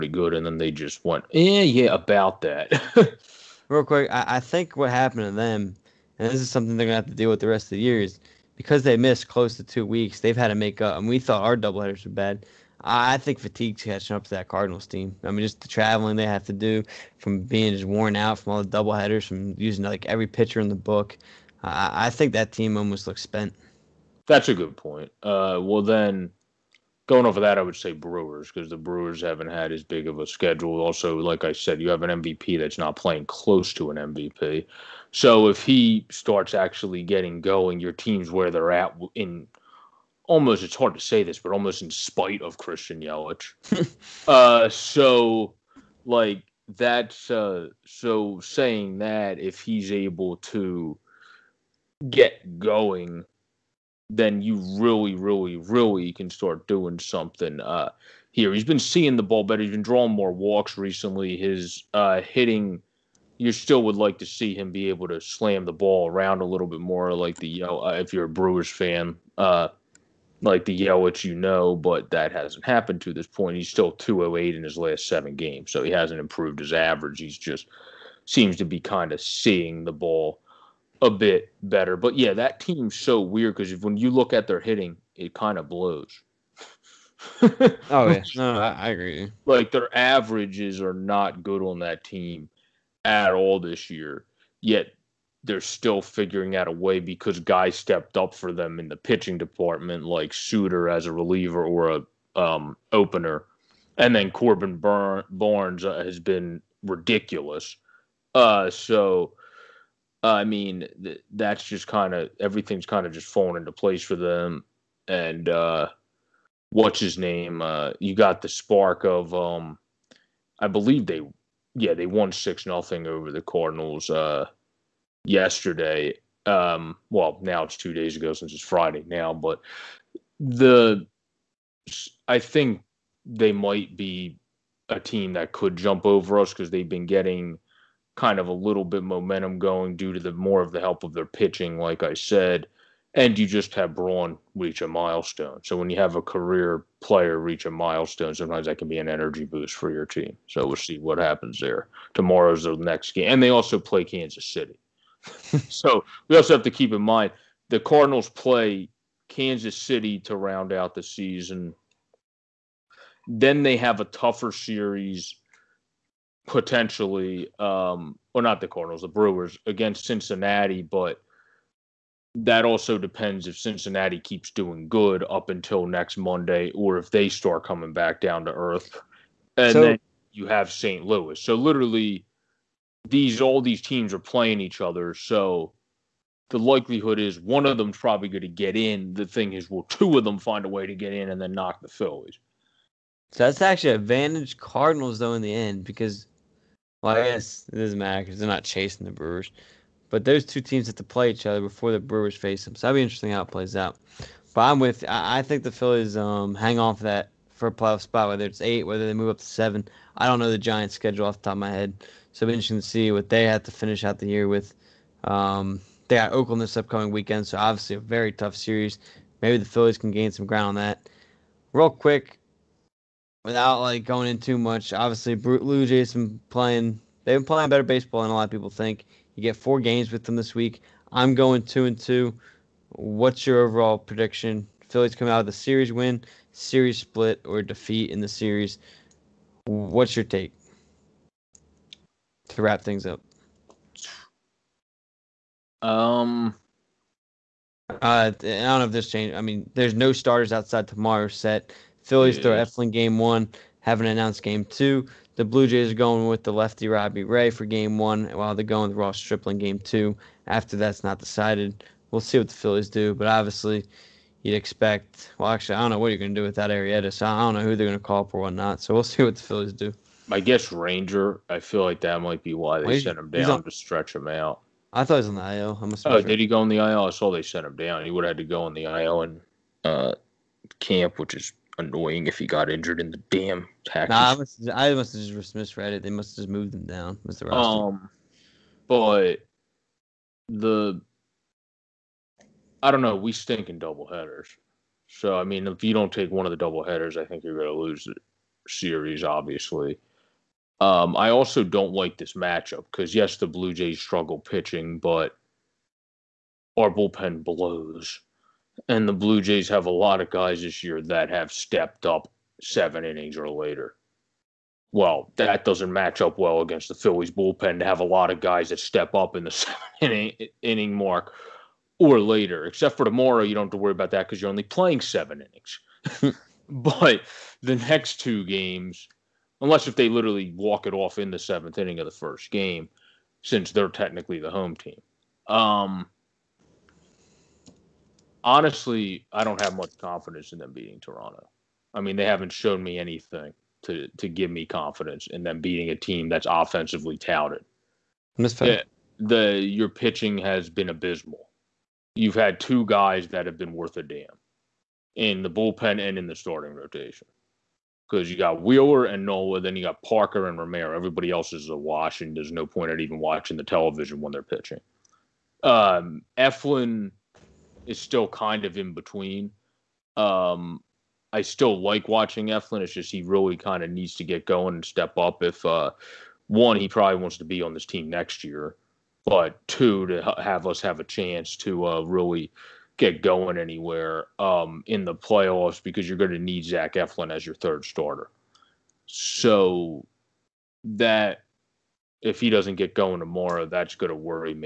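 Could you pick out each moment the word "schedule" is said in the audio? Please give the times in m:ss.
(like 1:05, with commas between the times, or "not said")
0:30, 3:30.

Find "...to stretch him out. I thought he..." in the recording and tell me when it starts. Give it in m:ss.
4:33.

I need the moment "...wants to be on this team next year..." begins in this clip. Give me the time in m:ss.
6:17.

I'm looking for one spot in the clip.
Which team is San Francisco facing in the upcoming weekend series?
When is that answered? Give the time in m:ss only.
3:36.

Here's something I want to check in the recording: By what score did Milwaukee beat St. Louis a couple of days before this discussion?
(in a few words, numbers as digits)
6-0.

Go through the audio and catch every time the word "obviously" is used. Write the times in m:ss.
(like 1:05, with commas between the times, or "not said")
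3:37, 3:44, 4:23, 4:59.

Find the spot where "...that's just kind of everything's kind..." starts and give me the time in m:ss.
1:51.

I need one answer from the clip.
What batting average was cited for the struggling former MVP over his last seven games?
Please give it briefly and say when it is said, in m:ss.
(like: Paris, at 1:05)
208, at 1:13.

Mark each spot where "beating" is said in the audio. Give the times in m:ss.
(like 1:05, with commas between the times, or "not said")
5:40, 5:45.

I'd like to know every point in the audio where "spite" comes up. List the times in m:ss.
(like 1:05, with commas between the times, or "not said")
0:41.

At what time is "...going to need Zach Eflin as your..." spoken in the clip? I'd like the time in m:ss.
6:26.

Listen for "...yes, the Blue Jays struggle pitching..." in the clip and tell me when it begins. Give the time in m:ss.
5:03.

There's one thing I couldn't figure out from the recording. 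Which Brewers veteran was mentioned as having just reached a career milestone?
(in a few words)
Braun.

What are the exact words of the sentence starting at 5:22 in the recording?
Except for tomorrow, you don't have to worry about that because you're only playing seven innings.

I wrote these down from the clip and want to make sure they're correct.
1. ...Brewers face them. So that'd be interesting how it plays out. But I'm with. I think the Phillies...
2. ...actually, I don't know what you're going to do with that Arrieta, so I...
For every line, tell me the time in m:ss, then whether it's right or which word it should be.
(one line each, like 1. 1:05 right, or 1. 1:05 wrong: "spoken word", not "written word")
1. 3:21 right
2. 4:25 right.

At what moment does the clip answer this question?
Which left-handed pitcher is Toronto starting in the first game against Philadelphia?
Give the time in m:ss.
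4:16.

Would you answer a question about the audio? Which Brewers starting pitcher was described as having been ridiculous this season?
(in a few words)
Corbin Burnes.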